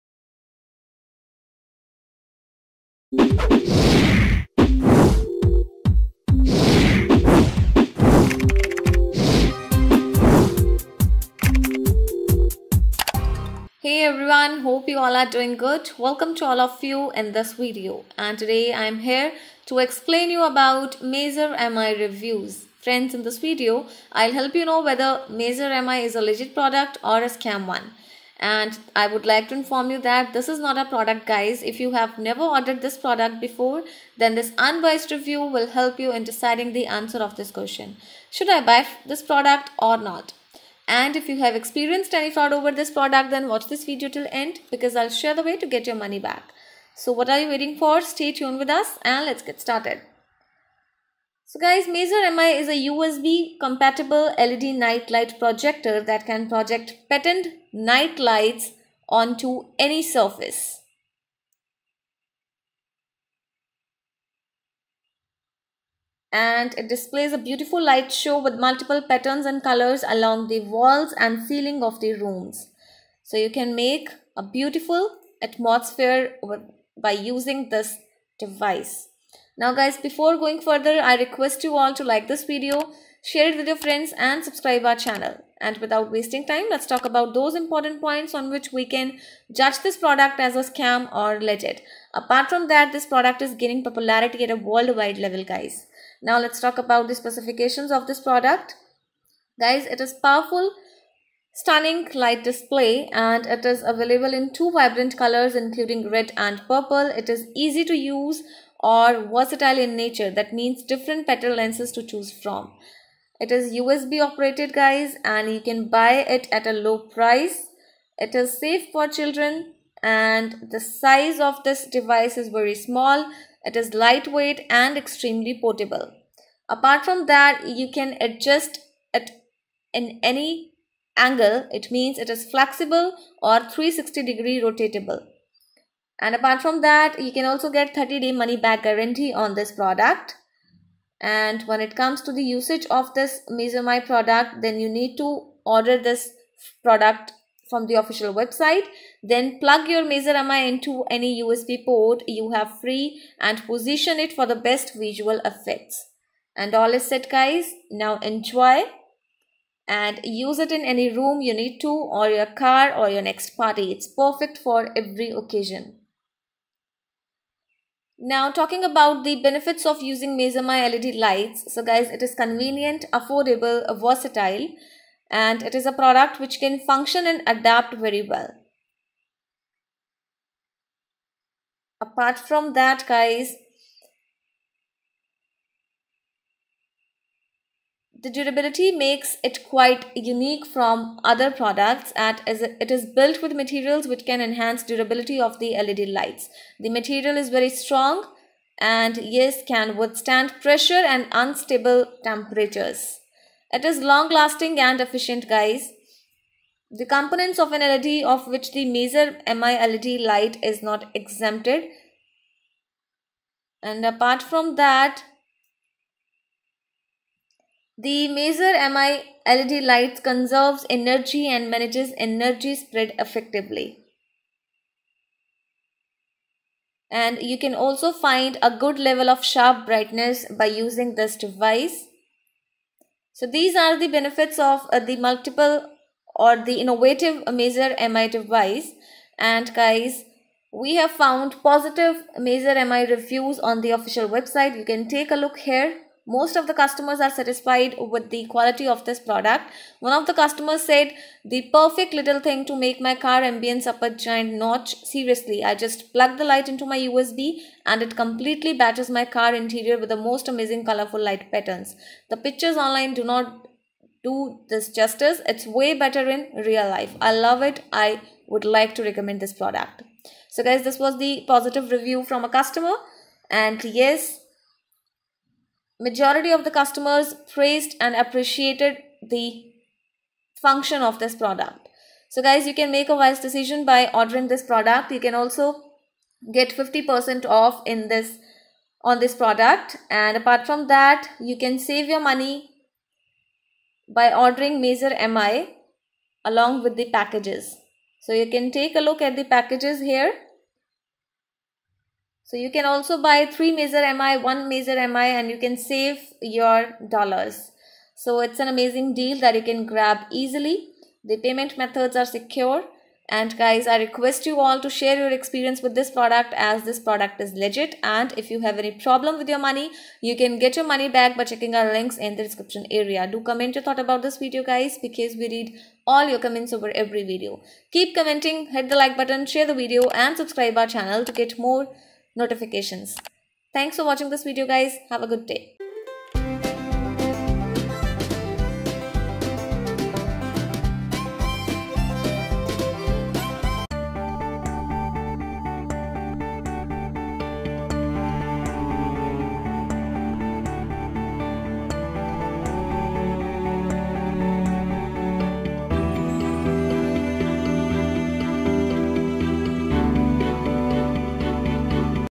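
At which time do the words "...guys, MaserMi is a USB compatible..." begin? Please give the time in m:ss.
0:51.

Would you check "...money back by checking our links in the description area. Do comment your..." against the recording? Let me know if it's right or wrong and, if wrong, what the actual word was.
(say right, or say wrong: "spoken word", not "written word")
right.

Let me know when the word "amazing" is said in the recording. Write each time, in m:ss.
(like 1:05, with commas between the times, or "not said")
4:20, 5:08.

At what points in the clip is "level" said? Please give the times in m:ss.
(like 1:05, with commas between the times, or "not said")
1:35, 3:48.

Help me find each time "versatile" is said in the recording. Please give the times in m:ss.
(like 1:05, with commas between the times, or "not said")
1:49, 2:54.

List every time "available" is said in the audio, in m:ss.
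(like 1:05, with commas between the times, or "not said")
1:43.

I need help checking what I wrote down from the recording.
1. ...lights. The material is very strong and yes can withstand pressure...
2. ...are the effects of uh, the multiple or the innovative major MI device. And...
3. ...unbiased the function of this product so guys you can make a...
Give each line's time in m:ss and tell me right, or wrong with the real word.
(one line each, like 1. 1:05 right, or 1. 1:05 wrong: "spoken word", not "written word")
1. 3:16 right
2. 3:53 wrong: "benefits", not "effects"
3. 4:38 wrong: "appreciated", not "unbiased".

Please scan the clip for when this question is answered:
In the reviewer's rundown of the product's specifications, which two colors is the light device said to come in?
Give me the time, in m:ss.
1:46.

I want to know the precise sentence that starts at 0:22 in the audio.
Friends, in this video, I'll help you know whether Major MI is a legit product or a scam one.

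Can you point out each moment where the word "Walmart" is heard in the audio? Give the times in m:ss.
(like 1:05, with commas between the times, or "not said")
not said.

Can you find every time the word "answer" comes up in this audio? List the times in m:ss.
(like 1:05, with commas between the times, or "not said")
0:36.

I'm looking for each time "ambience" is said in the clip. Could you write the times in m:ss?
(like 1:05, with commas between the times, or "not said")
4:13.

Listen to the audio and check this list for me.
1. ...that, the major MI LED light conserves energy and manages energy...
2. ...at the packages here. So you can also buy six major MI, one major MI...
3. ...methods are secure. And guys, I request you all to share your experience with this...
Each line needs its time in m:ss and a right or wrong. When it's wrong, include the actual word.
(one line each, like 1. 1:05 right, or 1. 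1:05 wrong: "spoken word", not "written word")
1. 3:34 right
2. 4:59 wrong: "three", not "six"
3. 5:11 right.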